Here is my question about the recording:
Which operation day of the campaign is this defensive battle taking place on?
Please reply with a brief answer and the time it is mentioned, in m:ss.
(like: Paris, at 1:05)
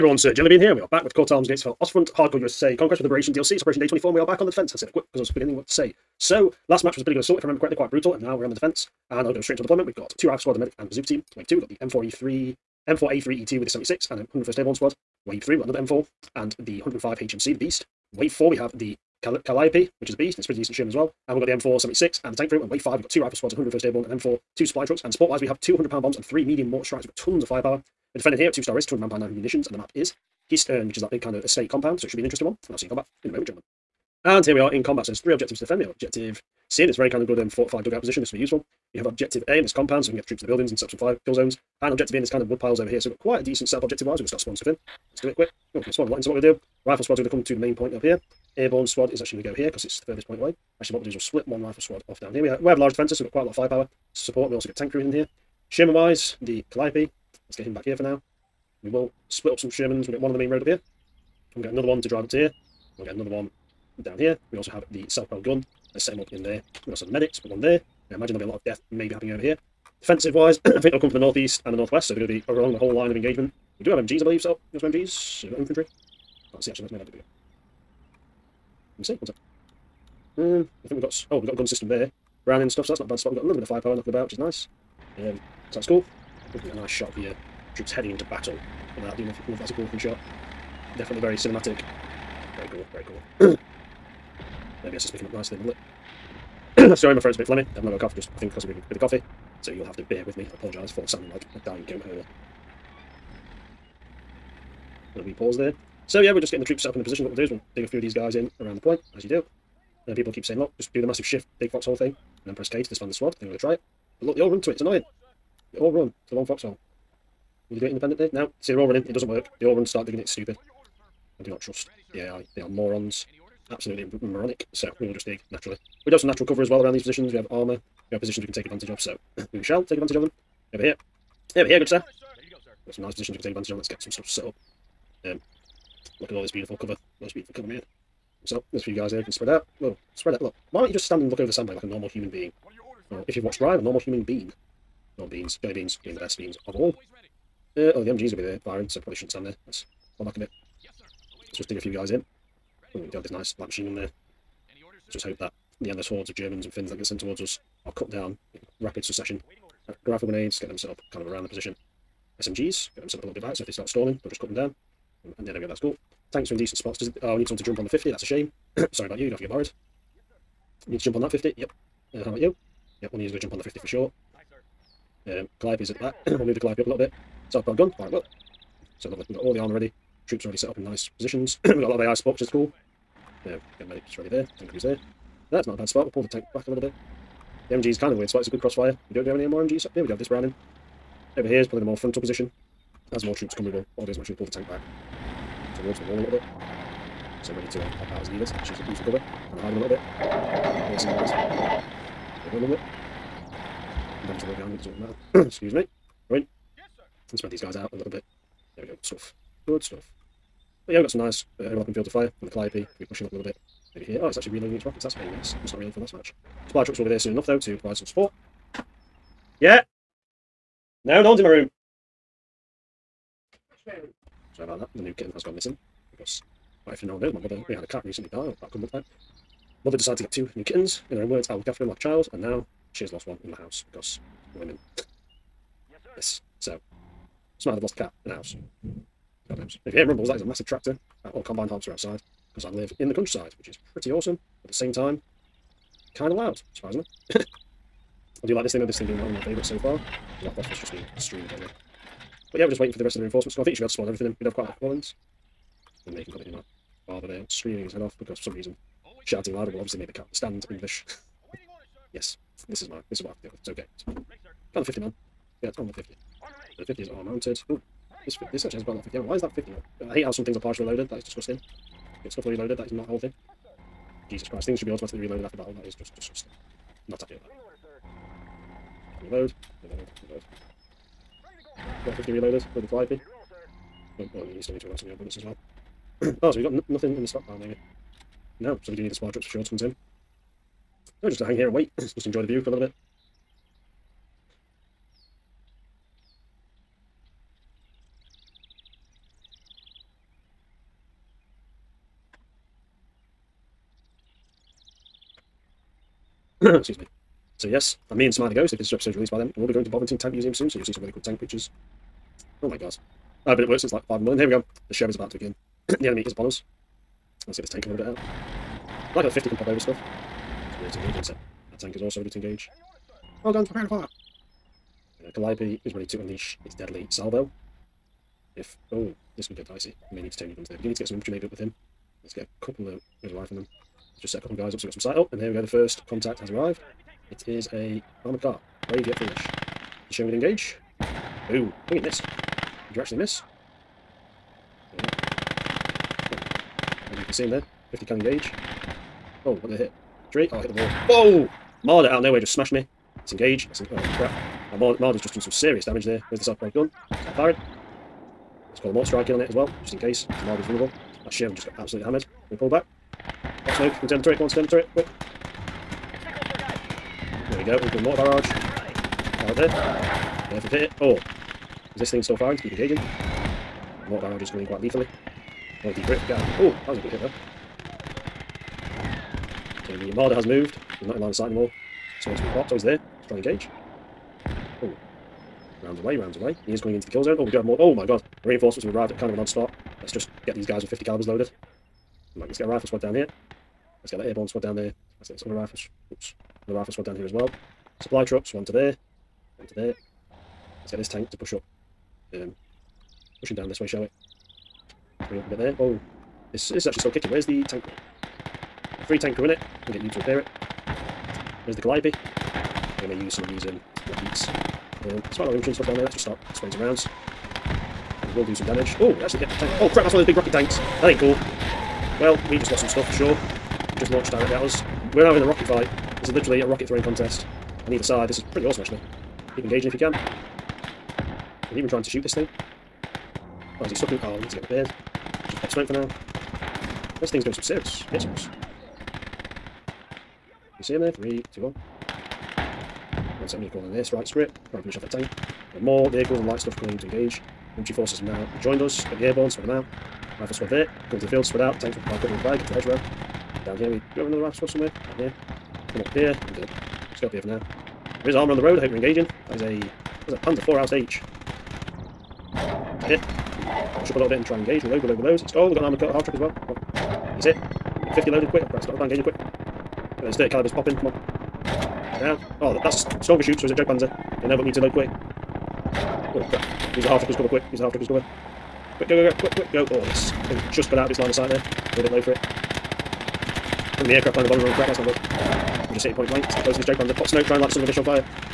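24, at 0:03.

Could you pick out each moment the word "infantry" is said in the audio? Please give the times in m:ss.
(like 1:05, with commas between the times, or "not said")
1:15, 5:31, 6:55, 7:27.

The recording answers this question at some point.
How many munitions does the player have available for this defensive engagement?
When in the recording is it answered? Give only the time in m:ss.
0:29.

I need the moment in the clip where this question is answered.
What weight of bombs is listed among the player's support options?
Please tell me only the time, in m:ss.
0:25.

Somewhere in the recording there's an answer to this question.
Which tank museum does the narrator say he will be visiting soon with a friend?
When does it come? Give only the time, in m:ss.
5:09.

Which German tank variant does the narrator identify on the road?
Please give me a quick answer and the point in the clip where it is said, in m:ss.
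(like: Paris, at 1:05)
Panzer 4 Ausf H, at 7:40.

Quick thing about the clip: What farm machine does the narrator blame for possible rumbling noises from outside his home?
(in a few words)
Combine harvester.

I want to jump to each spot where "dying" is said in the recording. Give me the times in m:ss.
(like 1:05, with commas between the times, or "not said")
1:41.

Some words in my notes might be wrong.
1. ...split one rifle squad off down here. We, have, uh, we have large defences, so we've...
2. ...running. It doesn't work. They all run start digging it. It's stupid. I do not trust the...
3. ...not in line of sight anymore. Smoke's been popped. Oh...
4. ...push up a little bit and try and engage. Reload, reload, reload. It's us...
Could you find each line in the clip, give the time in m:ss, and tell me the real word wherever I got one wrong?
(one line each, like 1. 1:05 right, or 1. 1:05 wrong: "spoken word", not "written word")
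1. 0:51 right
2. 1:58 right
3. 6:21 right
4. 7:44 right.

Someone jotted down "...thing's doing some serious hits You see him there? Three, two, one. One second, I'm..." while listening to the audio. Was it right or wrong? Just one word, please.
right.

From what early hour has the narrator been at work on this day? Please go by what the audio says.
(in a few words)
5 in the morning.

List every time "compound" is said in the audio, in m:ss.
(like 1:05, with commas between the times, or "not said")
0:31, 0:39.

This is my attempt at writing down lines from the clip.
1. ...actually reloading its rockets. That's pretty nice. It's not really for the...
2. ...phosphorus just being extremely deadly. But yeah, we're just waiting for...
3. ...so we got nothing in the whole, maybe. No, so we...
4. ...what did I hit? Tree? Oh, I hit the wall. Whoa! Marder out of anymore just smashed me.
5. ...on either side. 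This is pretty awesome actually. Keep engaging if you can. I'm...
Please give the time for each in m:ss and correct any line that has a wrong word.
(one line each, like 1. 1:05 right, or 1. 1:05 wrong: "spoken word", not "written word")
1. 3:34 right
2. 4:10 right
3. 4:46 wrong: "stockpile", not "whole"
4. 5:49 wrong: "nowhere", not "anymore"
5. 7:07 right.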